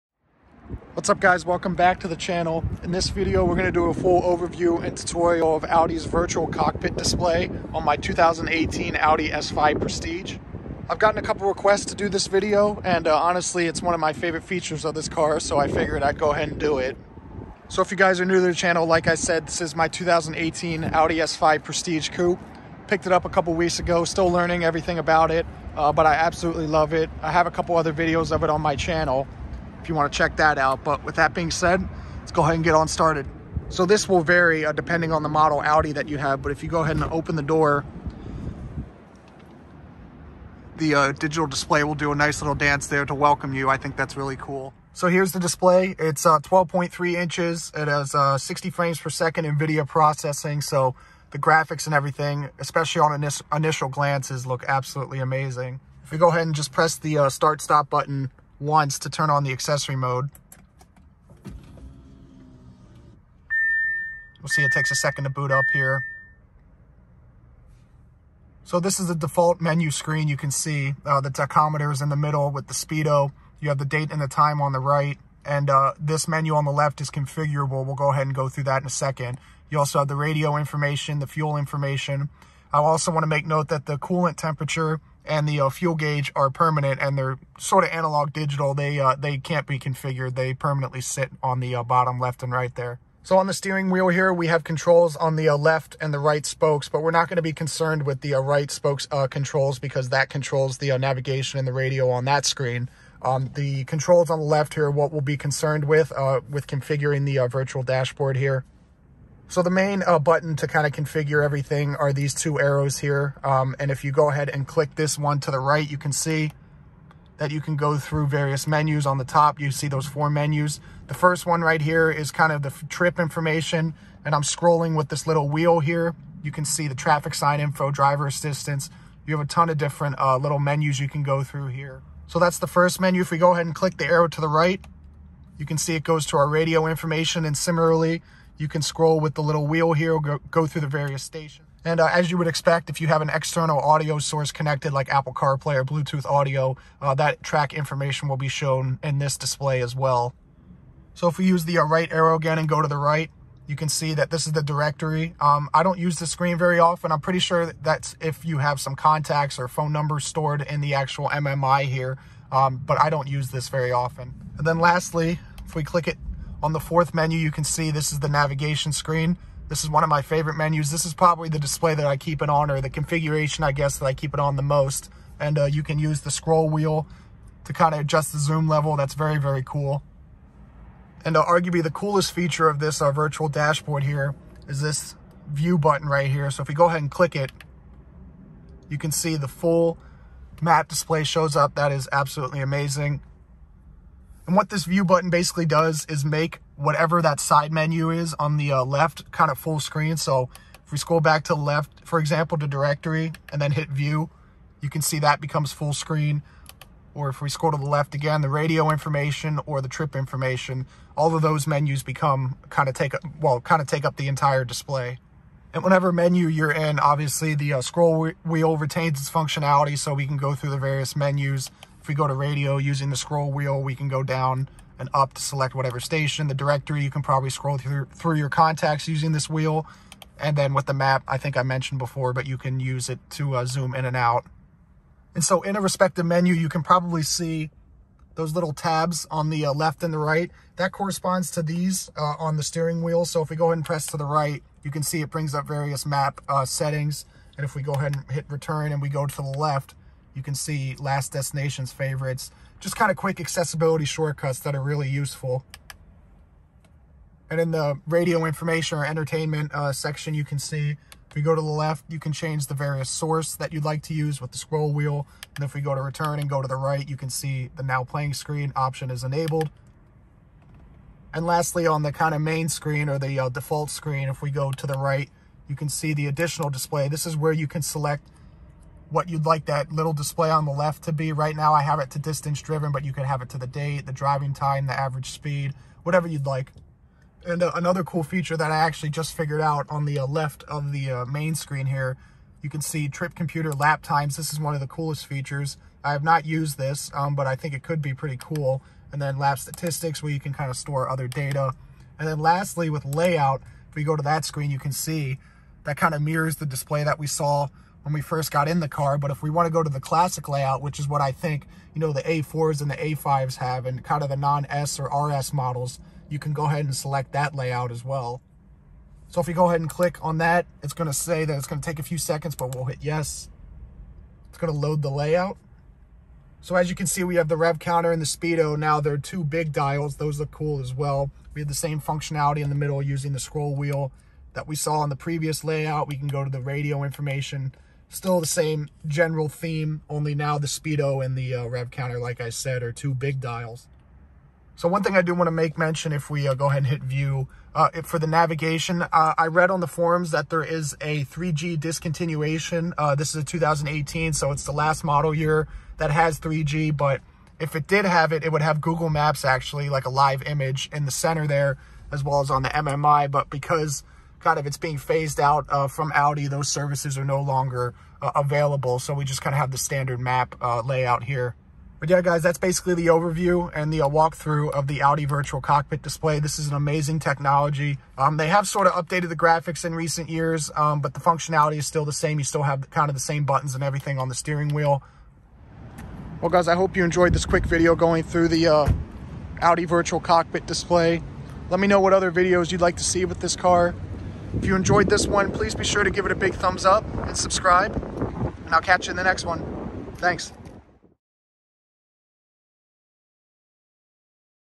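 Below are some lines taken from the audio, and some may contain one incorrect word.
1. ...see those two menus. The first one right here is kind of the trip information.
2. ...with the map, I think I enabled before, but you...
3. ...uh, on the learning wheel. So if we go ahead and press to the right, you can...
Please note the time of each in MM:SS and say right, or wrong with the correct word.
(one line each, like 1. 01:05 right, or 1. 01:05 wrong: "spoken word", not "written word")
1. 01:59 wrong: "four", not "two"
2. 03:50 wrong: "mentioned", not "enabled"
3. 04:02 wrong: "steering", not "learning".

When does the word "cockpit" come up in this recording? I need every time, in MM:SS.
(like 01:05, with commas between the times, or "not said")
00:06, 06:15, 06:30.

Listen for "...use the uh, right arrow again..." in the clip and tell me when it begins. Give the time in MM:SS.
02:31.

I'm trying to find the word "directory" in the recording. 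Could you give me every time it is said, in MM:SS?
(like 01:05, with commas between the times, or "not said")
02:34, 03:22, 03:46.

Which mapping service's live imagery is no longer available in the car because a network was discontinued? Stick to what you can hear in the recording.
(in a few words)
Google Maps.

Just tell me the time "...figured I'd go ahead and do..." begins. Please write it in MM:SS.
00:15.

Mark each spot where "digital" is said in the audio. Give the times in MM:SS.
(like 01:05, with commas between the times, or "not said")
00:41, 01:28.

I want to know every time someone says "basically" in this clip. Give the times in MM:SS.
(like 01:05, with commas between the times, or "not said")
03:15, 06:12.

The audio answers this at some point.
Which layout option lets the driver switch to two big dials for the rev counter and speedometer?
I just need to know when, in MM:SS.
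05:09.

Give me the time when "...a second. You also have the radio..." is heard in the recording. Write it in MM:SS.
01:18.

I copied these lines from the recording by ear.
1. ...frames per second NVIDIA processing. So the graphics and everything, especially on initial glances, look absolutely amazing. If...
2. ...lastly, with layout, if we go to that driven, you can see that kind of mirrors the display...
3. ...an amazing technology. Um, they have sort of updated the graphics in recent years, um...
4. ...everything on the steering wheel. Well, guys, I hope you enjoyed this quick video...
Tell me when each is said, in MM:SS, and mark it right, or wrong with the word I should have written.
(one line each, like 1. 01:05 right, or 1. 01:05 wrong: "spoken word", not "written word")
1. 00:48 right
2. 05:02 wrong: "screen", not "driven"
3. 06:16 right
4. 06:23 right.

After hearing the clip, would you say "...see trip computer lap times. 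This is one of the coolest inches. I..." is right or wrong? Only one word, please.
wrong.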